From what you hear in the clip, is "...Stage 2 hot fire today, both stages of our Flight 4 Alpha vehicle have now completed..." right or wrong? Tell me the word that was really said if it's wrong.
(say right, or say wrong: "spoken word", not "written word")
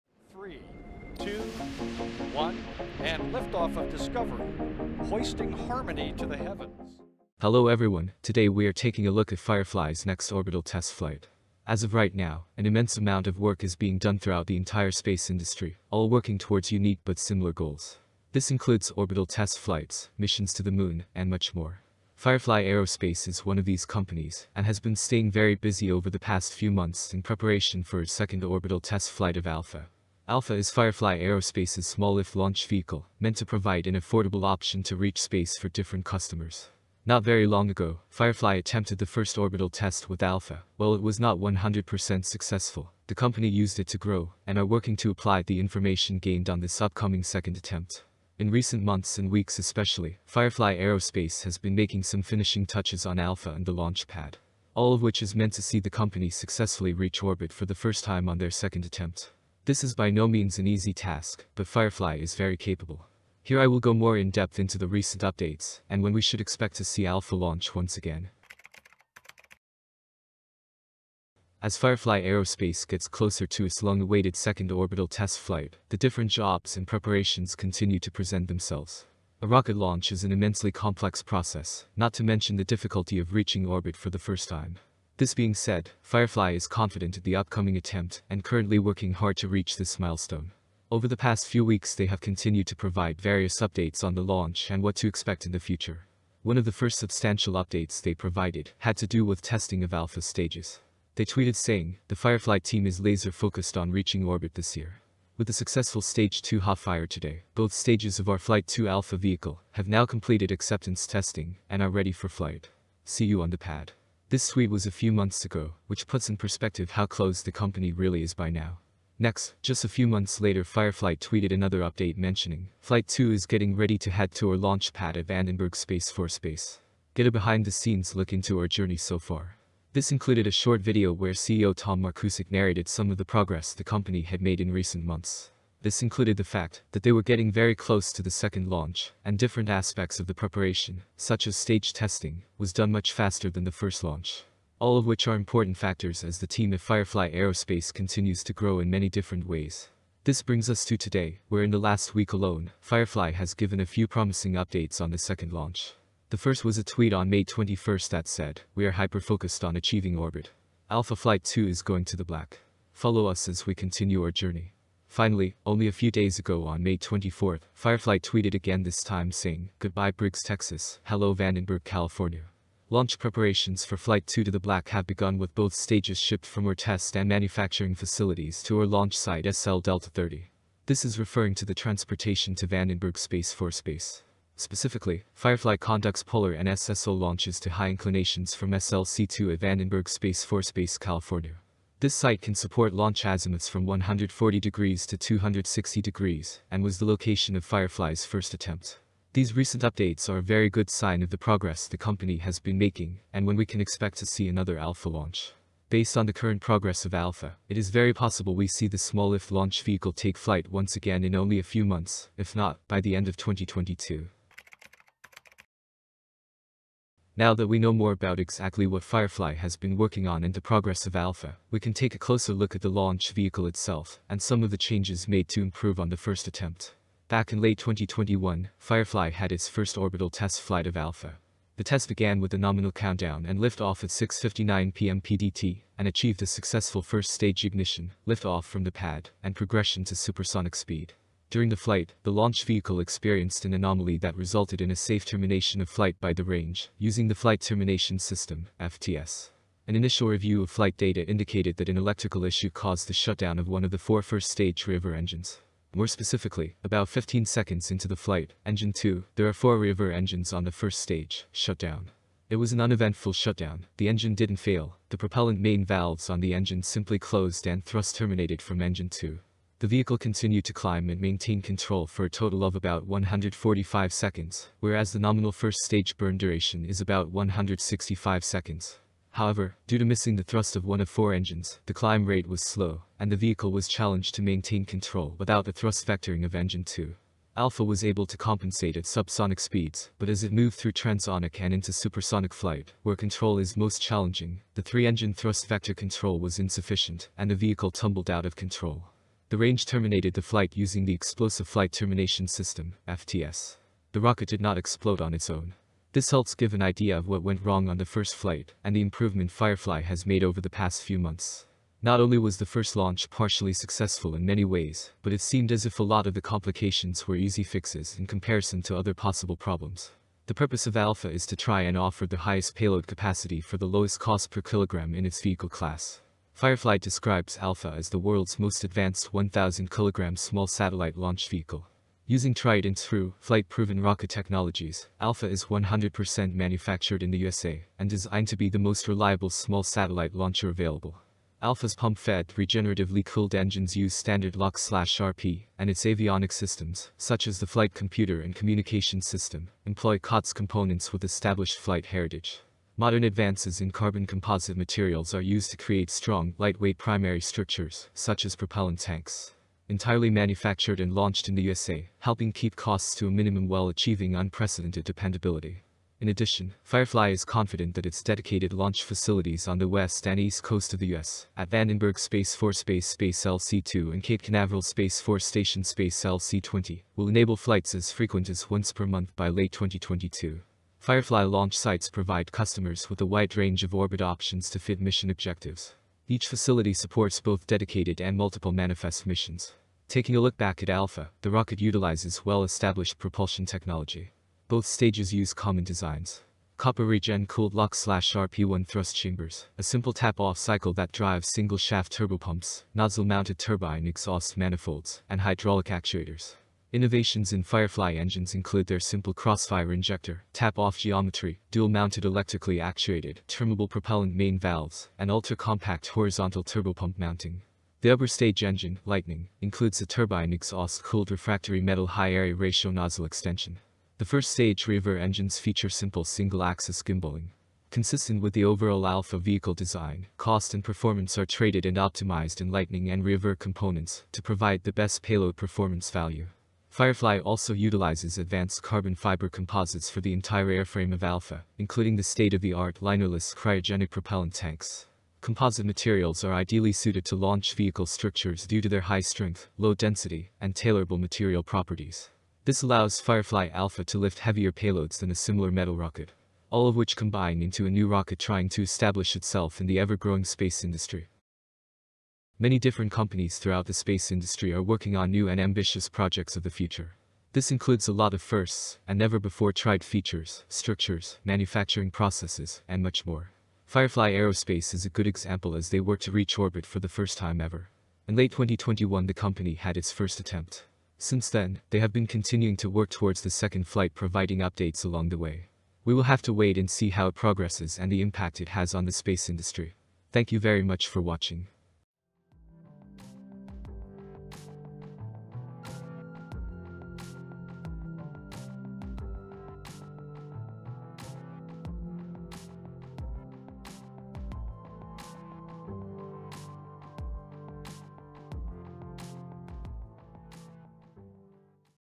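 wrong: "2", not "4".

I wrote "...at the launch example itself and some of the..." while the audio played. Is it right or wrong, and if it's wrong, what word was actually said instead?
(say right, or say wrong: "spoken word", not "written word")
wrong: "vehicle", not "example".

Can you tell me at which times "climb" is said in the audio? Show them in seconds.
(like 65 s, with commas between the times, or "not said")
270 s, 281 s.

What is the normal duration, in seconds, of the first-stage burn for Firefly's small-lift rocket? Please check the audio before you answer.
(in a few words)
165.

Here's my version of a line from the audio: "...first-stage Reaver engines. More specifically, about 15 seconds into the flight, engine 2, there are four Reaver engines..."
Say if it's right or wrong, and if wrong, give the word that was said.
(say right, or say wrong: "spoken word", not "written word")
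right.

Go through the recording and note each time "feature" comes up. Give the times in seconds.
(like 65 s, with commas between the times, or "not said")
425 s, 470 s.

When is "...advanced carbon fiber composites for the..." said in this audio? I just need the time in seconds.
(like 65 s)
438 s.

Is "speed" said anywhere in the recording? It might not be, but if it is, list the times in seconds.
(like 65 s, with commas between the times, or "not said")
240 s, 289 s.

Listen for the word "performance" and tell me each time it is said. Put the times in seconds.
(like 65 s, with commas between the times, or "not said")
430 s, 435 s.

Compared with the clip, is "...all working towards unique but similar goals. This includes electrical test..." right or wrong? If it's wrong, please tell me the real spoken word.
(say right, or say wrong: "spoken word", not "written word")
wrong: "orbital", not "electrical".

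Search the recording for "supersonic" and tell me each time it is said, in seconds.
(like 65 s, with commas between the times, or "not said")
240 s, 291 s.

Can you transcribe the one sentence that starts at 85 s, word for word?
This being said, Firefly is confident in the upcoming attempt and currently working hard to reach this milestone.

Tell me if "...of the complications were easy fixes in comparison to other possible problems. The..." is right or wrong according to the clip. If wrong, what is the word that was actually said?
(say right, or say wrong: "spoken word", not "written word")
right.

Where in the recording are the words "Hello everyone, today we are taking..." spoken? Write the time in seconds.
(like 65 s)
7 s.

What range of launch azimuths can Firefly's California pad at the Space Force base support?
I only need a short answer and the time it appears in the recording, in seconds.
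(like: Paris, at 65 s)
140 to 260 degrees, at 193 s.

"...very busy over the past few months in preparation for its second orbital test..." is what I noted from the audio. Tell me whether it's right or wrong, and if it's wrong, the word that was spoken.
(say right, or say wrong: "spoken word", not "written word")
right.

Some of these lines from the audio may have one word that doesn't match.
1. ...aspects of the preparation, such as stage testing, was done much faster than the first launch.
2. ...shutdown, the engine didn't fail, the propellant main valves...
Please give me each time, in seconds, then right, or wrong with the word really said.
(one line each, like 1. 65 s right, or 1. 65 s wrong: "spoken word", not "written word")
1. 139 s right
2. 263 s right.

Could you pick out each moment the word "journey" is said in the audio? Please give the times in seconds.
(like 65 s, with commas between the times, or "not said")
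128 s, 164 s.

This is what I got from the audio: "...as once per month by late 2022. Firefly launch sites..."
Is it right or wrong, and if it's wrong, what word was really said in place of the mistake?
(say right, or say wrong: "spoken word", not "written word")
right.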